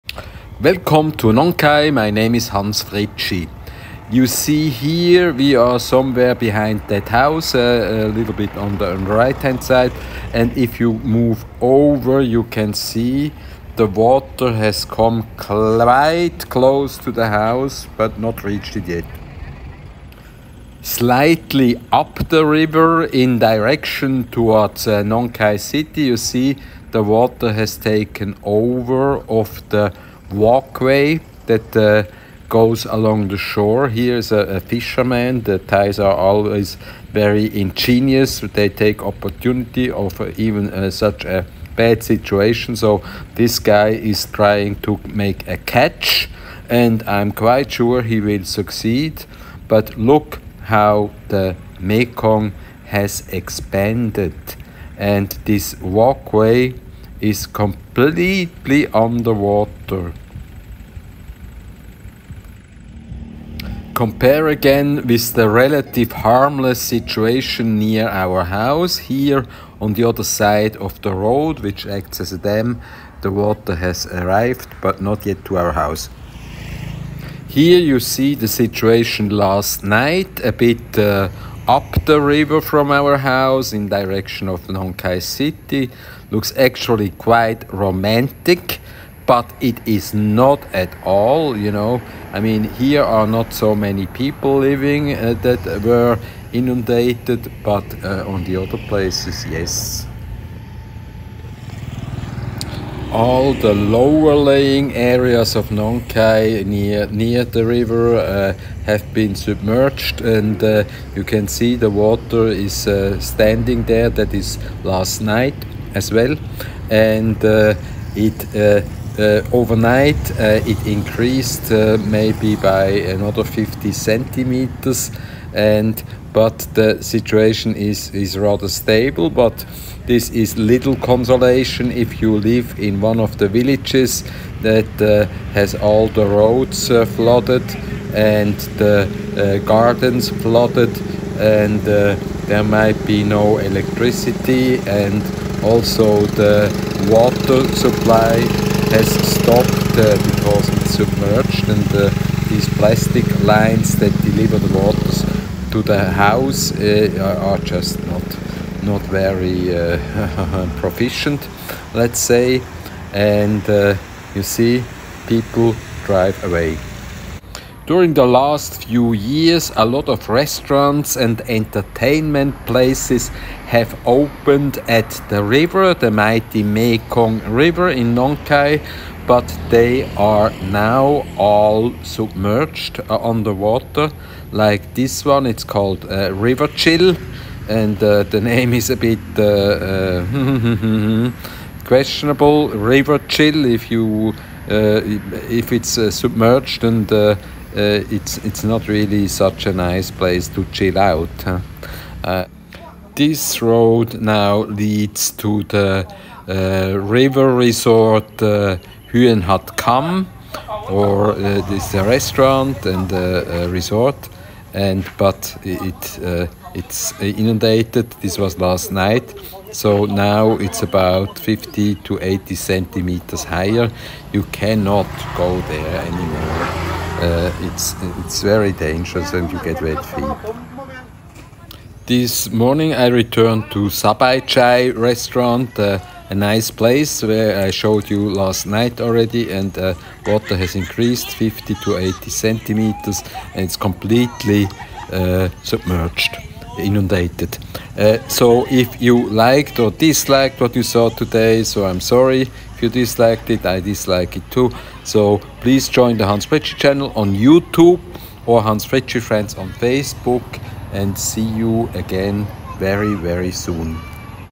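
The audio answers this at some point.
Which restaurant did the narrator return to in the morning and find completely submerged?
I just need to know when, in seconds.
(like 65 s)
233 s.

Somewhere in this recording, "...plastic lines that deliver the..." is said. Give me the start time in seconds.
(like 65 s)
152 s.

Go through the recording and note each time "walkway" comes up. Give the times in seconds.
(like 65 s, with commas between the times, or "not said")
30 s, 55 s.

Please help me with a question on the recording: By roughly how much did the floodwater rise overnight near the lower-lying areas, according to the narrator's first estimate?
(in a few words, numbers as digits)
50 centimeters.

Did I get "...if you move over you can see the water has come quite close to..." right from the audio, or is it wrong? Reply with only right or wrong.
right.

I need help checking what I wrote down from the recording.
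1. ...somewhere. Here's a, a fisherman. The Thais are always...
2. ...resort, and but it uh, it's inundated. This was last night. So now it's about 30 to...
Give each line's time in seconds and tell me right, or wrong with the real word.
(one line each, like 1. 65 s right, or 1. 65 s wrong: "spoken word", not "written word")
1. 33 s wrong: "shore", not "somewhere"
2. 213 s wrong: "50", not "30".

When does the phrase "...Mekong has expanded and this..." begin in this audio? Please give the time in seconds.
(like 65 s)
51 s.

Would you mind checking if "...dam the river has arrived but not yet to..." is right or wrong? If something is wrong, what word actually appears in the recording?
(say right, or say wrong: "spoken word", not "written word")
wrong: "water", not "river".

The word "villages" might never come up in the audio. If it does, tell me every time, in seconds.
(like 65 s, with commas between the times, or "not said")
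133 s.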